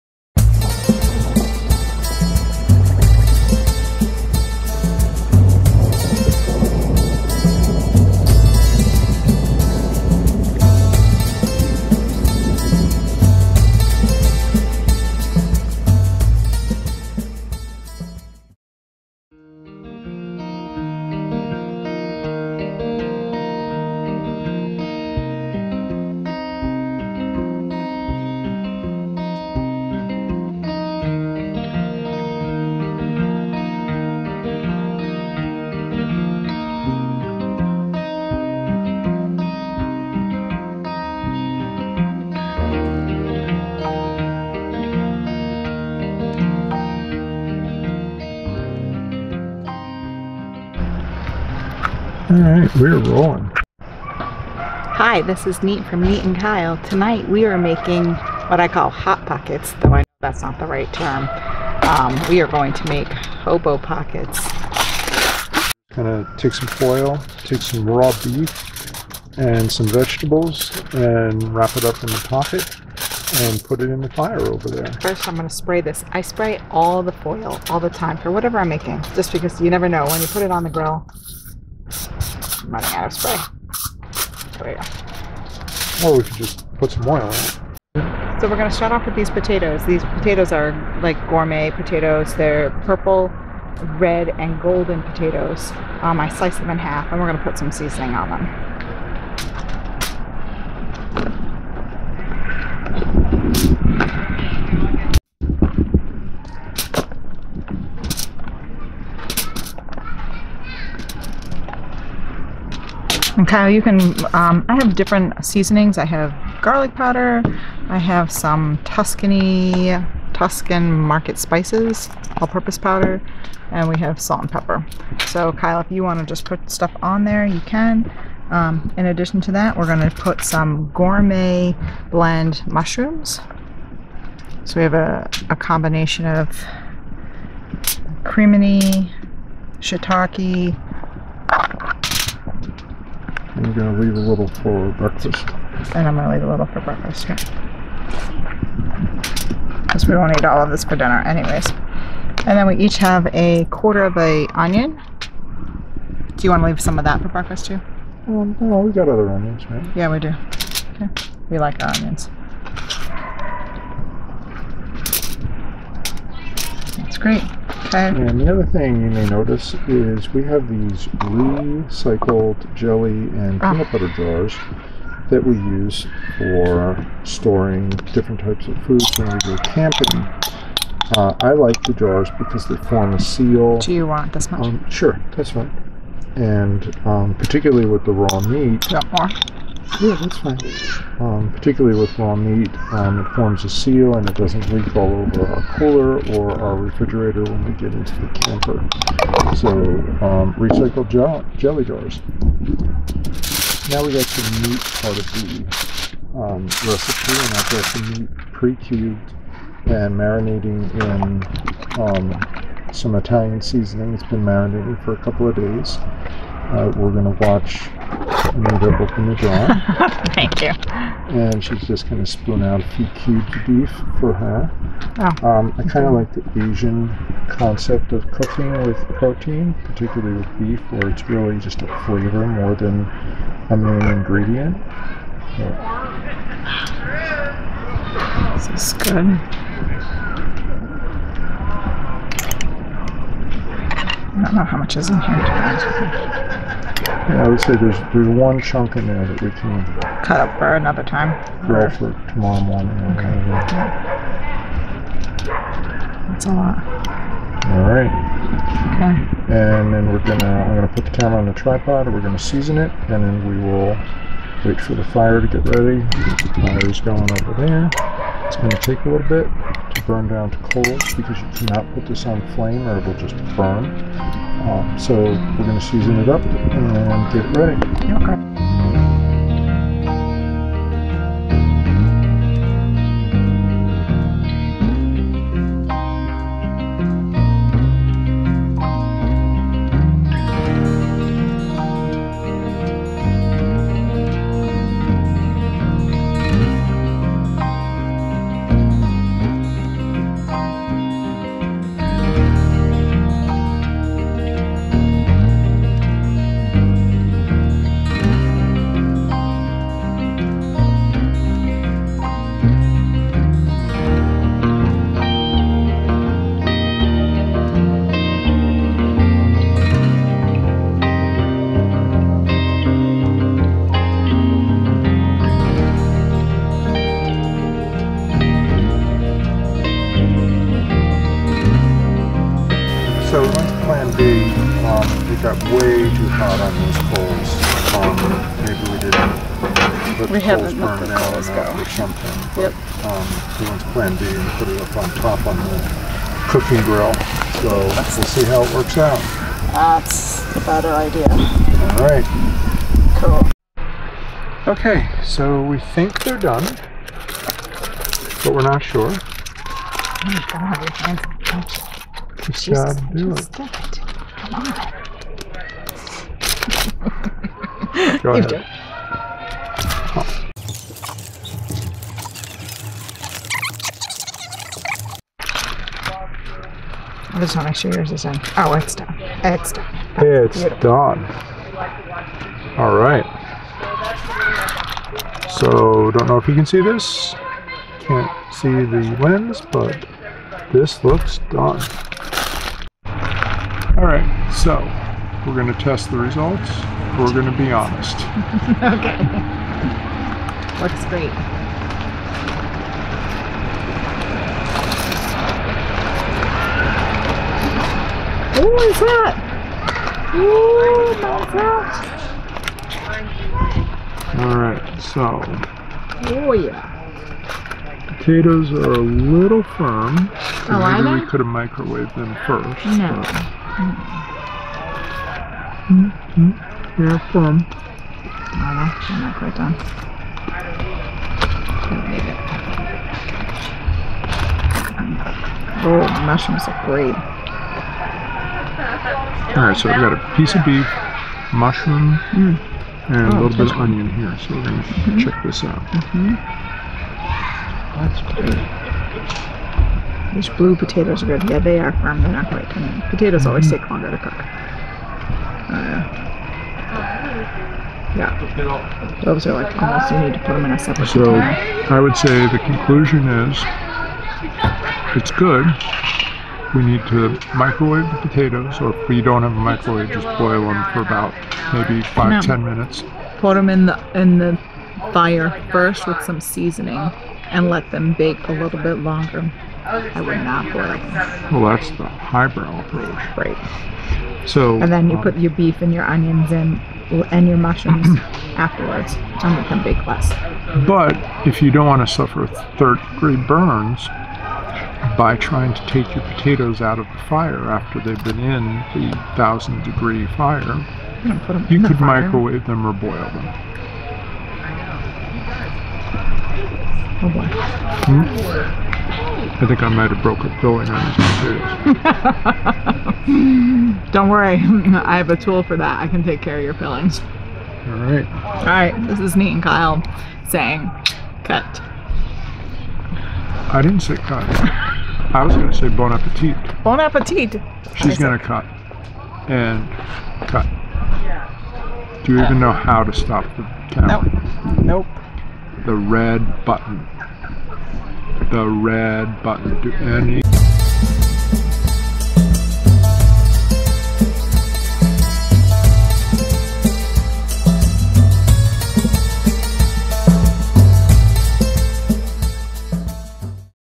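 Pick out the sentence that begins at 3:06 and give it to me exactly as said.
And um, particularly with the raw meat.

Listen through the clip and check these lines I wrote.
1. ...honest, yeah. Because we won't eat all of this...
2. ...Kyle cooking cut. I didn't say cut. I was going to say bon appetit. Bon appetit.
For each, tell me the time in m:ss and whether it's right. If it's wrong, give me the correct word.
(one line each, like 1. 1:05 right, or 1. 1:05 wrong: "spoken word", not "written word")
1. 2:26 wrong: "breakfast", not "honest"
2. 8:39 wrong: "saying", not "cooking".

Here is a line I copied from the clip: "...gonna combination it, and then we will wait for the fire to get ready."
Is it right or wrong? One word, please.
wrong.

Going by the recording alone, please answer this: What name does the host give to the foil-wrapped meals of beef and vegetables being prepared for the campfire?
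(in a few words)
hobo pockets.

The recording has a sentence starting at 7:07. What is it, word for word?
No, no, you're not quite done.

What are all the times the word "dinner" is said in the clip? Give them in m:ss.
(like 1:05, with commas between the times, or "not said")
2:30.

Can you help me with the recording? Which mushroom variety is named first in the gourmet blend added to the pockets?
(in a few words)
crimini.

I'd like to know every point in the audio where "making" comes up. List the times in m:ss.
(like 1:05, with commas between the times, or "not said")
0:57, 1:18.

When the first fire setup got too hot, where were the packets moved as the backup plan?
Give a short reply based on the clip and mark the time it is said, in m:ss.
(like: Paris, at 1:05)
the cooking grill, at 5:46.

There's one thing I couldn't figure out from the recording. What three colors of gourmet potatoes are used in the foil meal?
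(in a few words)
purple, red, and golden.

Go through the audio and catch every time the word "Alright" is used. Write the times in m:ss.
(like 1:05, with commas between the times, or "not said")
0:52, 6:34, 6:54, 7:19.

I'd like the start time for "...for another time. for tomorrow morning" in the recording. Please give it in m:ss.
4:10.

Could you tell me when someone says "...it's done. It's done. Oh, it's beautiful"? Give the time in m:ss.
6:18.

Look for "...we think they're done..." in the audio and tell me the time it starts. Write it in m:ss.
5:55.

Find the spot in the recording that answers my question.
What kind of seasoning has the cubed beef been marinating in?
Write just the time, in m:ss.
3:33.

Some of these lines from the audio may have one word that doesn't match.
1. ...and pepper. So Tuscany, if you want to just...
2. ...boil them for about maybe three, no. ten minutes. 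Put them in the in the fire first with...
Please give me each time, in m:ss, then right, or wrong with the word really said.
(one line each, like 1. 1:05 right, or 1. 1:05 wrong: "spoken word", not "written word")
1. 2:04 wrong: "Kyle", not "Tuscany"
2. 7:50 wrong: "five", not "three".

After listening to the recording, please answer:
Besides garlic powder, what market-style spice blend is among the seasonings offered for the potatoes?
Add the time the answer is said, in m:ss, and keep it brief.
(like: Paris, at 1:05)
Tuscan market spices, at 2:00.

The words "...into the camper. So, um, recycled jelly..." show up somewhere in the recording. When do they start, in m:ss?
3:17.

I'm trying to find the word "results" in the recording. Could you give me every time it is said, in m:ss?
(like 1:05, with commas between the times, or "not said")
6:36.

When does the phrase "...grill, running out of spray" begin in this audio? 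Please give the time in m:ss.
1:20.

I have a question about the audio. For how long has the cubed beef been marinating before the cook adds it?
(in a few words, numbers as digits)
a couple of days.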